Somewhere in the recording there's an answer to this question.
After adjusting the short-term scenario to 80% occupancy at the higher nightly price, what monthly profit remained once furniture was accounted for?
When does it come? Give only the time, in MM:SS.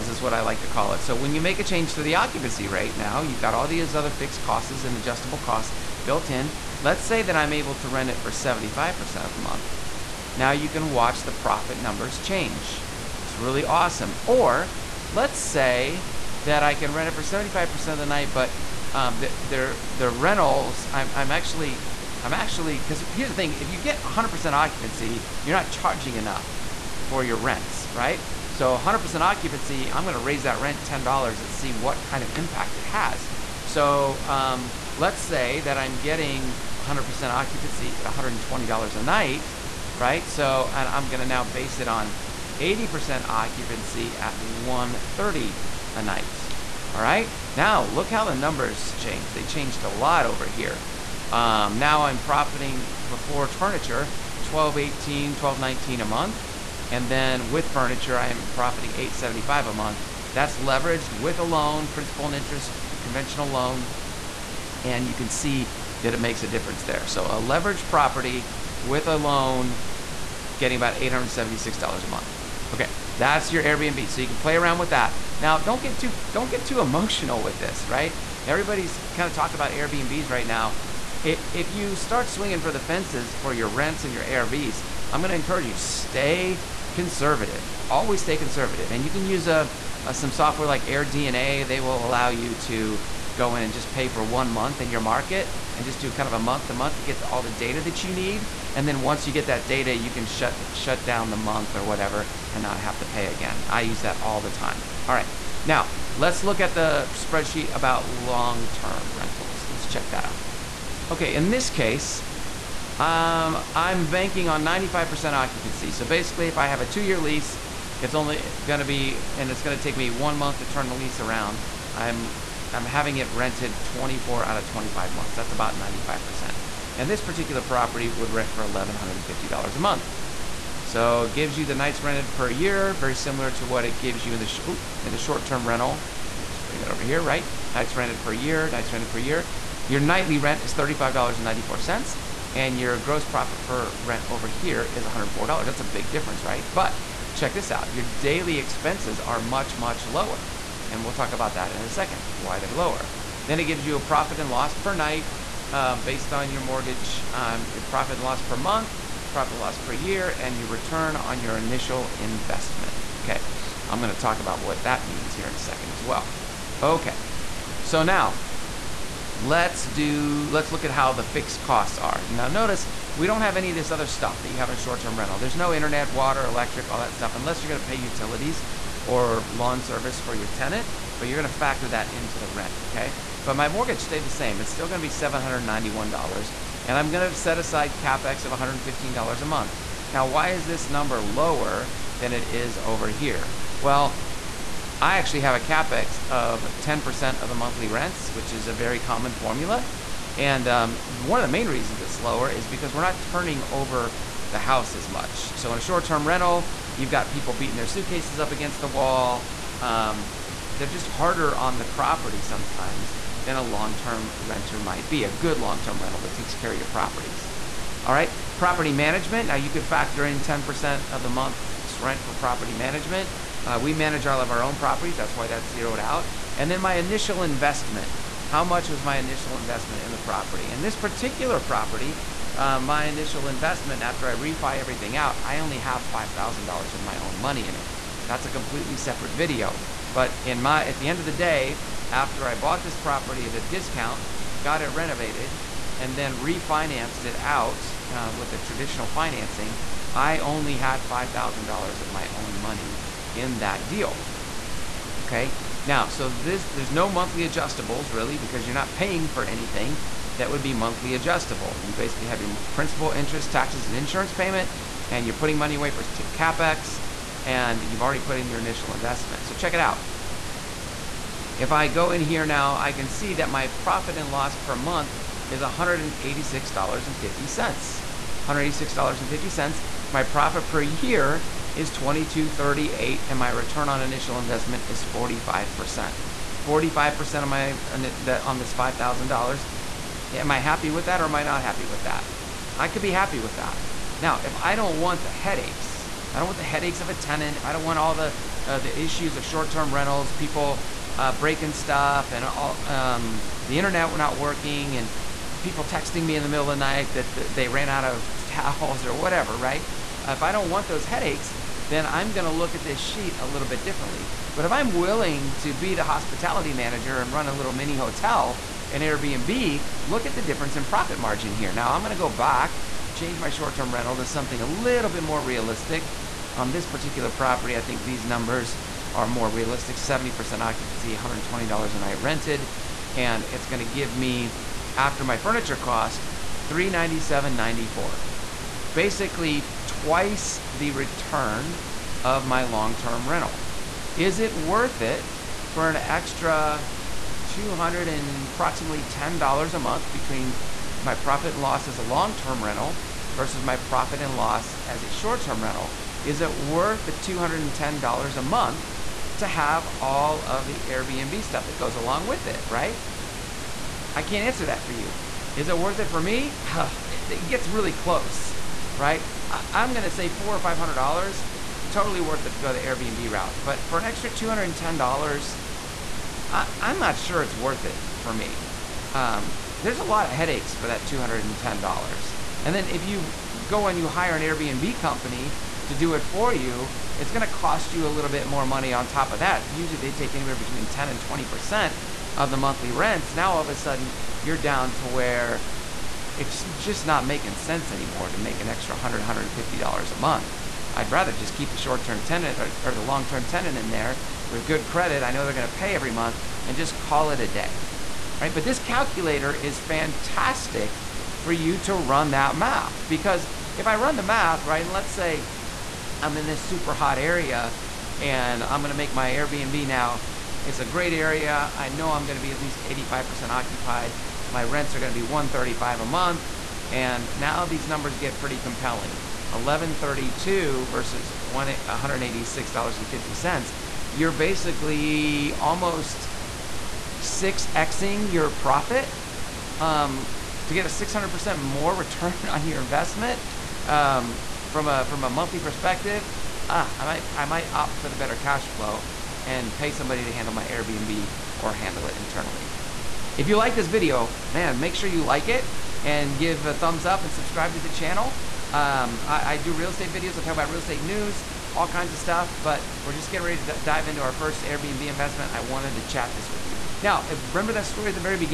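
00:58.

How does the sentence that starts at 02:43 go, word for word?
Okay, I'm gonna talk about what that means here in a second as well.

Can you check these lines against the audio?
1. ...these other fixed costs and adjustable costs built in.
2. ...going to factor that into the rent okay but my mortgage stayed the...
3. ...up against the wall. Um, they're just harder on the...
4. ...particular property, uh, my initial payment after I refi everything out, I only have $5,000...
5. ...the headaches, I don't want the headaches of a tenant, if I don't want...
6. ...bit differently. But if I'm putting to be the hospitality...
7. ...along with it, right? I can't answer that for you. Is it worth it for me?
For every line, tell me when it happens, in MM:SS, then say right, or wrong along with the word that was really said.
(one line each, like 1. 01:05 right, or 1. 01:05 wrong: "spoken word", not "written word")
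1. 00:03 right
2. 03:01 right
3. 03:28 right
4. 03:50 wrong: "investment", not "payment"
5. 04:55 right
6. 05:13 wrong: "willing", not "putting"
7. 06:01 right.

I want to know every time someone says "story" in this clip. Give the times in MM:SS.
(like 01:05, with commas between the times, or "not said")
07:47.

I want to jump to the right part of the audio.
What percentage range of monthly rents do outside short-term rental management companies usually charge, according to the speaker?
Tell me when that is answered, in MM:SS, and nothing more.
06:30.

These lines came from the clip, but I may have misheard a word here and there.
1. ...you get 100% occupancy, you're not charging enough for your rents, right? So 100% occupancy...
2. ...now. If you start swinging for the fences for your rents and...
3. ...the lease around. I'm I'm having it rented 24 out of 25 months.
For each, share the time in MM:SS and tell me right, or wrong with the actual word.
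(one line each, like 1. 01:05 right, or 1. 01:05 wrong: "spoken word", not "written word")
1. 00:23 right
2. 01:20 right
3. 02:00 right.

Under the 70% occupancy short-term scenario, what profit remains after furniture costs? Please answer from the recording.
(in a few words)
397.94.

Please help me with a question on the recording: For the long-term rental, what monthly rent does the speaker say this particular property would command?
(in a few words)
$1,150.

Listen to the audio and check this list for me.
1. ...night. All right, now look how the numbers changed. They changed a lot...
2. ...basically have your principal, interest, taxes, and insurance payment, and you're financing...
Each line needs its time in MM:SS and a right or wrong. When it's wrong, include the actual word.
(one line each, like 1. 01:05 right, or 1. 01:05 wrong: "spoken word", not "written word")
1. 00:46 right
2. 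04:21 wrong: "putting", not "financing".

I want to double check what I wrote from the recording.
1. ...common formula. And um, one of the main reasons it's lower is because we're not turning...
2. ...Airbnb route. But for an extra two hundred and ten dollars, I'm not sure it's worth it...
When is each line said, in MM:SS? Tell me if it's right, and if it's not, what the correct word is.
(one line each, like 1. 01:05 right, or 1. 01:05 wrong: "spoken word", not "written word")
1. 03:18 right
2. 06:12 right.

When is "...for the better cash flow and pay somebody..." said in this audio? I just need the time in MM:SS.
07:27.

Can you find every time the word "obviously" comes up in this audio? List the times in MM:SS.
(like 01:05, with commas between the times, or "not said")
not said.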